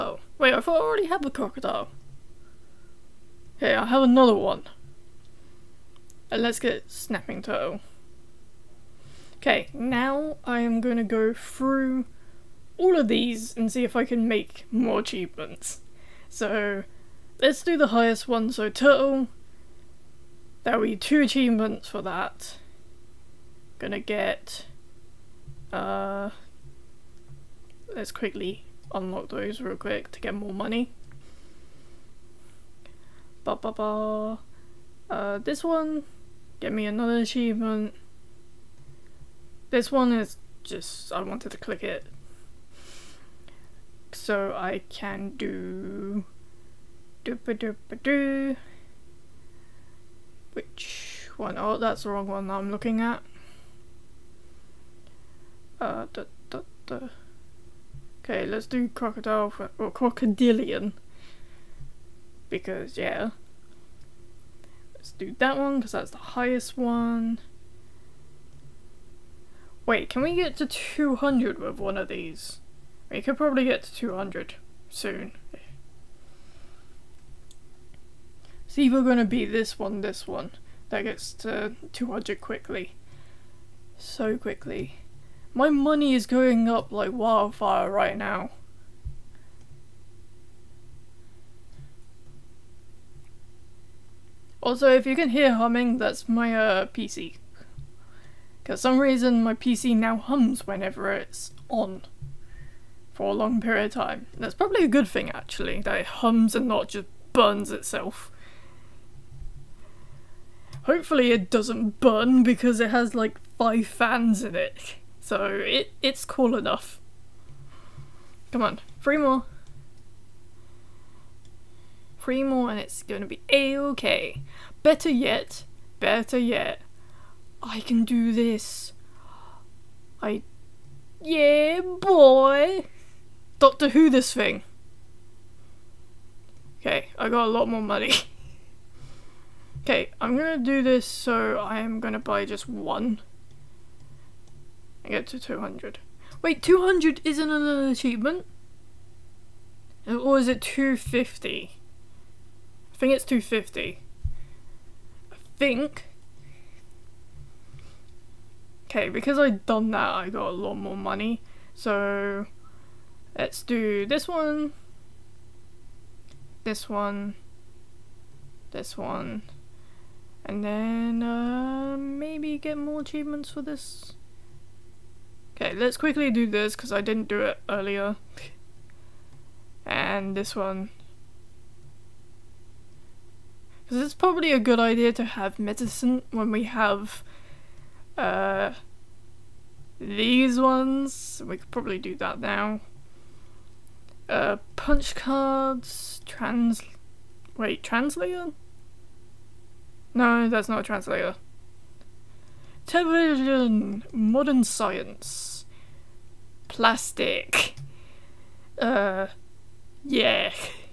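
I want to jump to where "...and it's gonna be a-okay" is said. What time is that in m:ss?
2:02.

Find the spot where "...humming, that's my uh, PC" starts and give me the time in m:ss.
1:35.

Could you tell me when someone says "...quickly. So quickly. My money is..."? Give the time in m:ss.
1:22.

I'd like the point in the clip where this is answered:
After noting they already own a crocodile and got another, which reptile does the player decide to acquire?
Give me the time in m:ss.
0:06.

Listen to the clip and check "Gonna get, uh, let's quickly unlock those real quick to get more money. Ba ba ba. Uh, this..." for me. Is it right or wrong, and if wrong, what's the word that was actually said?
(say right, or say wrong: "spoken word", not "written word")
right.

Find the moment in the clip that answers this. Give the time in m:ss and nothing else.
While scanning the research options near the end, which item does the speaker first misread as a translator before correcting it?
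3:22.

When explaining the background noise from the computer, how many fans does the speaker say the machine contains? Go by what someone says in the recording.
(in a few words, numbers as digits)
5.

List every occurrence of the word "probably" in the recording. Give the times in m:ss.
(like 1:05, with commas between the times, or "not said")
1:13, 1:44, 3:04, 3:11.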